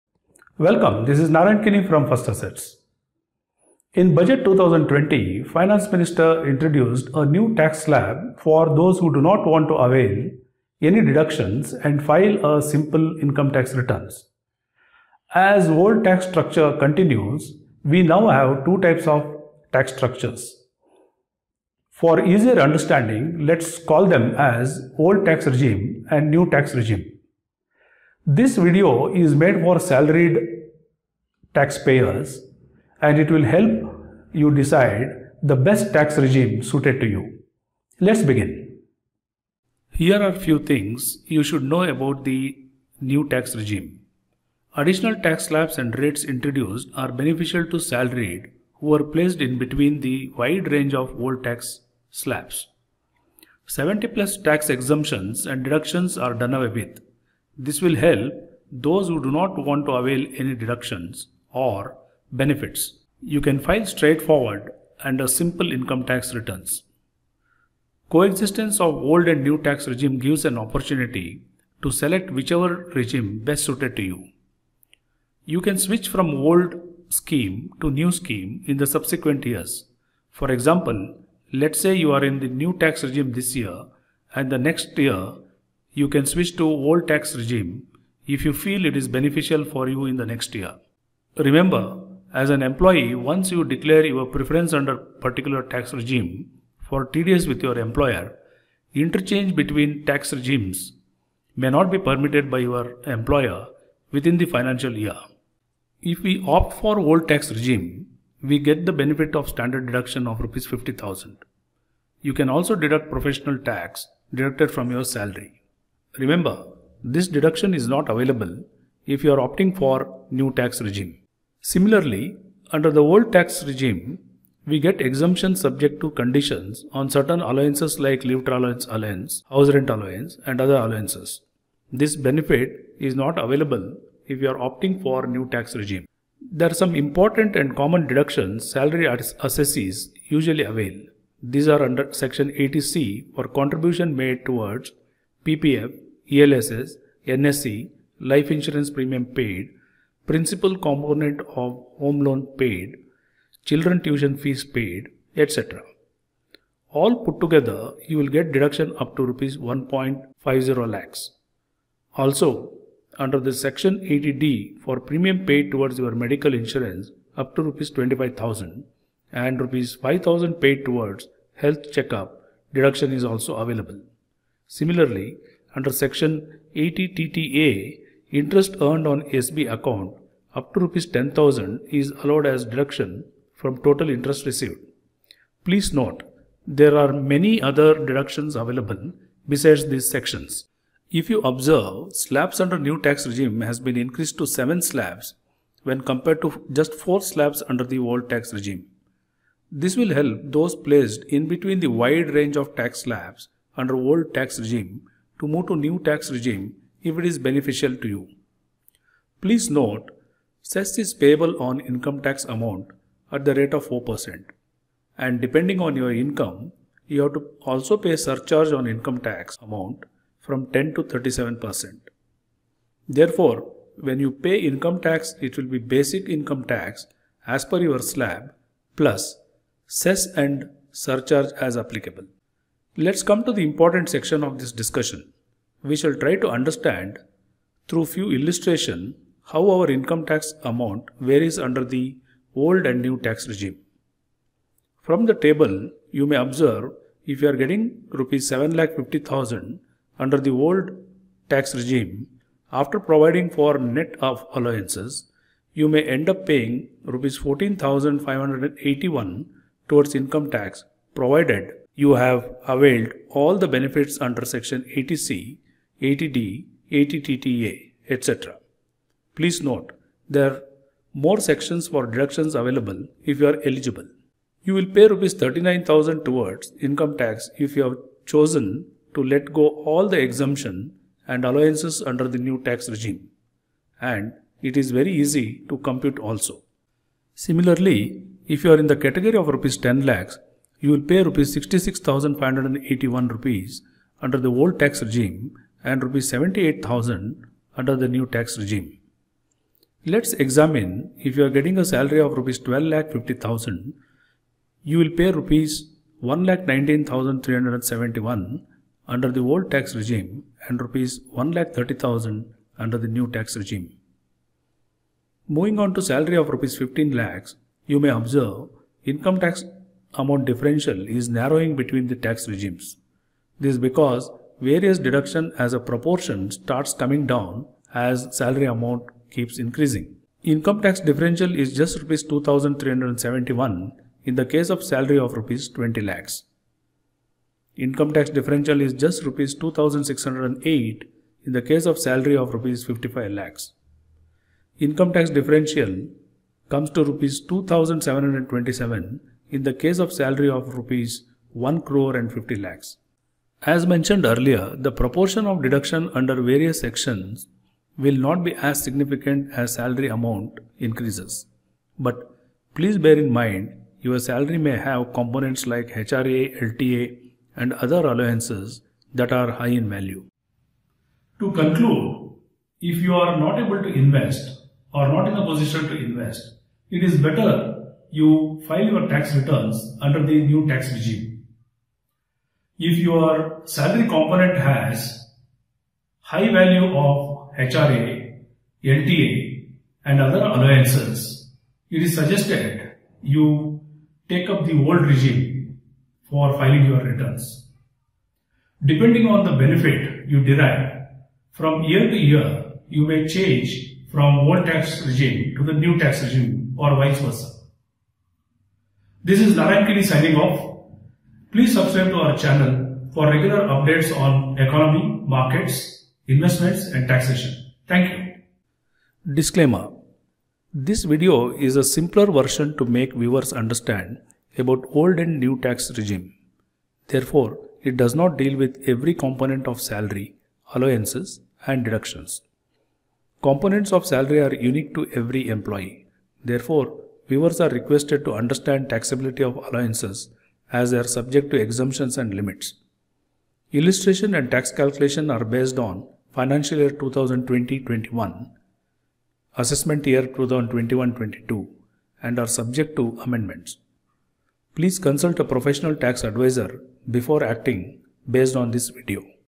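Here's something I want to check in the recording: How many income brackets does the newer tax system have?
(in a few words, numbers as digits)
7.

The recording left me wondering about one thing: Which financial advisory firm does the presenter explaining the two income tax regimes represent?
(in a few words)
First Assetz.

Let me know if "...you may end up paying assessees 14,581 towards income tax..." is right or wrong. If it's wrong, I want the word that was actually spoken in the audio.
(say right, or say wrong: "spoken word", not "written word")
wrong: "rupees", not "assessees".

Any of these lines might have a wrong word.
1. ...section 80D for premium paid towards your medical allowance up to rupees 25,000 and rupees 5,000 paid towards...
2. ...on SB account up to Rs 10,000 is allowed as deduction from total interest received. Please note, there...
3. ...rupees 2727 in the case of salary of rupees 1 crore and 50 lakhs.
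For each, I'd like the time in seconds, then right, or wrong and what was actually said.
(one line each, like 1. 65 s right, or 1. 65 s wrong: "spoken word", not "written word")
1. 163 s wrong: "insurance", not "allowance"
2. 179 s right
3. 347 s right.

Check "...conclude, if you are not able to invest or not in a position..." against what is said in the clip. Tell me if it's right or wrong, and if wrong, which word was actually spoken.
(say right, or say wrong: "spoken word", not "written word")
right.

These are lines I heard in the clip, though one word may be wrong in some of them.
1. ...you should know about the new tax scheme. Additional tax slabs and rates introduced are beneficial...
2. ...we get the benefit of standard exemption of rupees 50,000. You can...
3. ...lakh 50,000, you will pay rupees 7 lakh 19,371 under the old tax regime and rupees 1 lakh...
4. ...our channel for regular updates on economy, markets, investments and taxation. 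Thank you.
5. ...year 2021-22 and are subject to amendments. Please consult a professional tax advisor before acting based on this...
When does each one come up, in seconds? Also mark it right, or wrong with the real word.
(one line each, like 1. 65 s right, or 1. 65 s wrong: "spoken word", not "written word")
1. 41 s wrong: "regime", not "scheme"
2. 108 s wrong: "deduction", not "exemption"
3. 302 s wrong: "1", not "7"
4. 412 s right
5. 450 s right.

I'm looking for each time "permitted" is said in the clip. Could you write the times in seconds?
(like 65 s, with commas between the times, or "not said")
101 s.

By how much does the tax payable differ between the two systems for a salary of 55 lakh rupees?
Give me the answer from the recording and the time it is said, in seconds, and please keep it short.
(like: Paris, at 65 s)
Rs 2,608, at 339 s.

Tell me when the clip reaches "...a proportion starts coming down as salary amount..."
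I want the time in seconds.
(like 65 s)
325 s.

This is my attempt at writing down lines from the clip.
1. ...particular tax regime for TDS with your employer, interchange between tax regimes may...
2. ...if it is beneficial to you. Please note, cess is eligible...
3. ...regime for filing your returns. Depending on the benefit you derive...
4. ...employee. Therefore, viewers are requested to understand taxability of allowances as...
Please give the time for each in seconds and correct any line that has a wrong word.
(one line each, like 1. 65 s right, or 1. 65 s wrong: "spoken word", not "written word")
1. 94 s right
2. 207 s wrong: "payable", not "eligible"
3. 395 s right
4. 435 s right.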